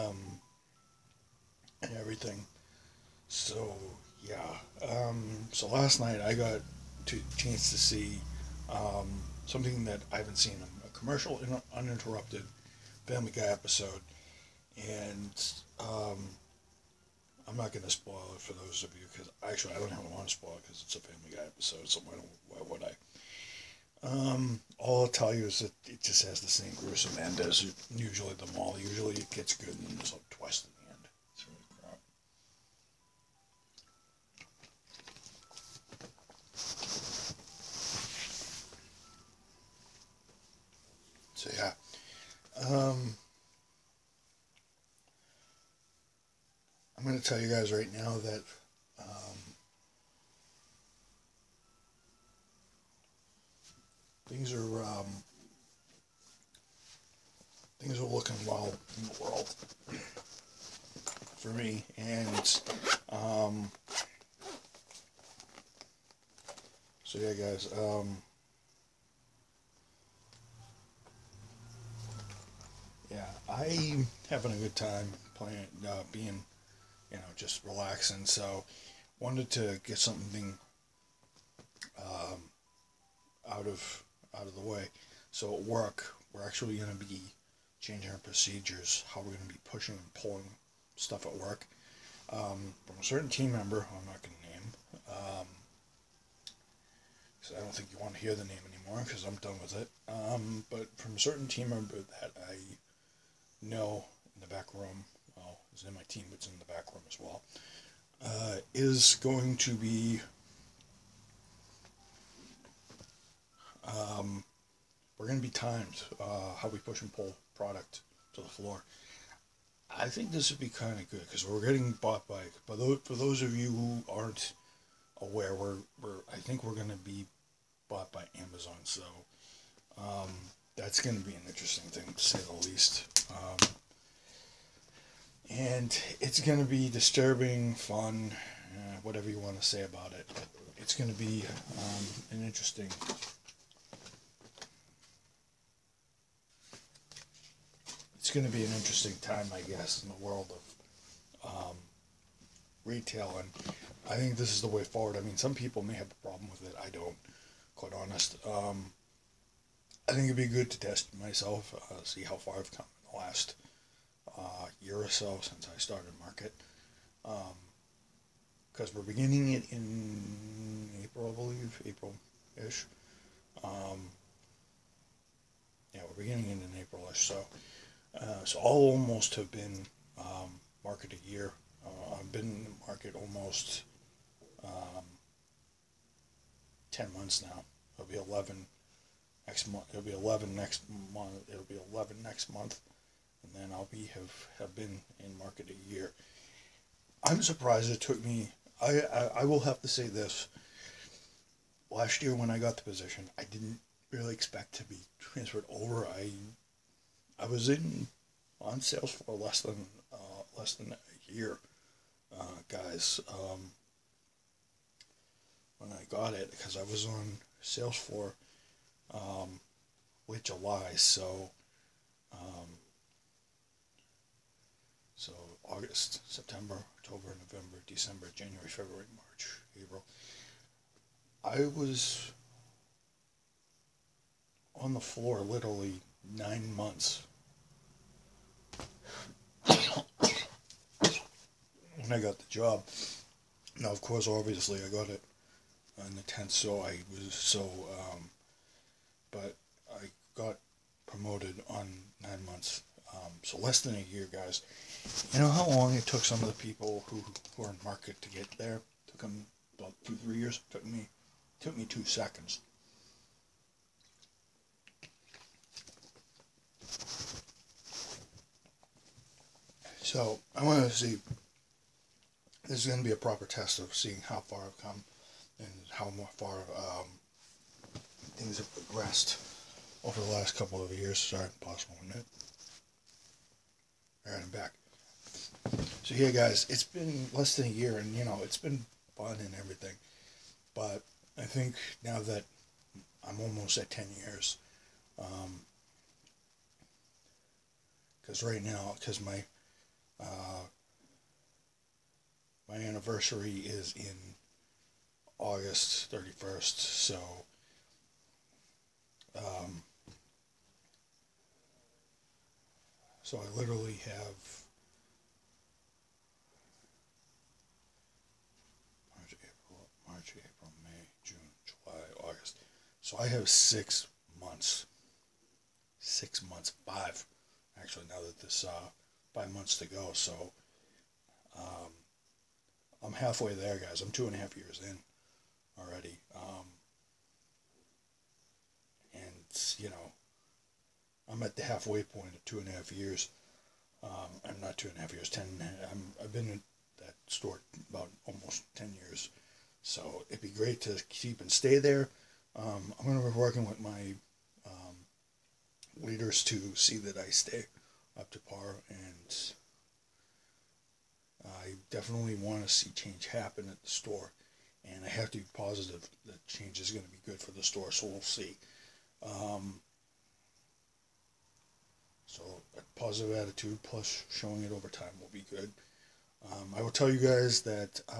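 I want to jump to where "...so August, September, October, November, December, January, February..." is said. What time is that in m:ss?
3:45.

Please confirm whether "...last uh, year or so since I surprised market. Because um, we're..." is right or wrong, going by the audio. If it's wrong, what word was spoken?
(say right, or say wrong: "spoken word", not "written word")
wrong: "started", not "surprised".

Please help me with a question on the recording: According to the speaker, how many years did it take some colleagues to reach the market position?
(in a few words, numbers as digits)
2 to 3 years.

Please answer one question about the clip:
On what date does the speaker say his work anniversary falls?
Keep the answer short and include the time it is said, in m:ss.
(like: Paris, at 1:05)
August 31, at 5:05.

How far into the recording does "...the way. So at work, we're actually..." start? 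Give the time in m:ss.
1:24.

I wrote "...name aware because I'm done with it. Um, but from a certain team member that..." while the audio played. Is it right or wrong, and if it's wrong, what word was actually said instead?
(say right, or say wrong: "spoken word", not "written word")
wrong: "anymore", not "aware".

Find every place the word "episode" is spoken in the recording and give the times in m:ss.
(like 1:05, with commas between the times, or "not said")
0:13, 0:21.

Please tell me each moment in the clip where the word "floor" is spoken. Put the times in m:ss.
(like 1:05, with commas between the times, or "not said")
1:58, 3:54.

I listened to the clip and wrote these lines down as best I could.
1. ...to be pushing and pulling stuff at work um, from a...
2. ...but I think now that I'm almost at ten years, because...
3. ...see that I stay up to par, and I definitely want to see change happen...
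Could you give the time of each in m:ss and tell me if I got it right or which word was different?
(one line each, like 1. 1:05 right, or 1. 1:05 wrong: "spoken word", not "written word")
1. 1:29 right
2. 4:50 right
3. 5:56 right.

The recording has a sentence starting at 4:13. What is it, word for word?
Um, so less than a year, guys.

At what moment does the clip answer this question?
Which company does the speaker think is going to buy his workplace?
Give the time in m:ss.
2:08.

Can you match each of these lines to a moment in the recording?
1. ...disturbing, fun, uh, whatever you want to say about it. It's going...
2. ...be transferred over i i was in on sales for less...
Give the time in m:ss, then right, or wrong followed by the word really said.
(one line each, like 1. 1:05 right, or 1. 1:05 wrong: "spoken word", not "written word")
1. 2:16 right
2. 3:24 right.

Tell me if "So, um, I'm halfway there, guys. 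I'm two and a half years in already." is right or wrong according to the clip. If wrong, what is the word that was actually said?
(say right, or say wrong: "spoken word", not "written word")
right.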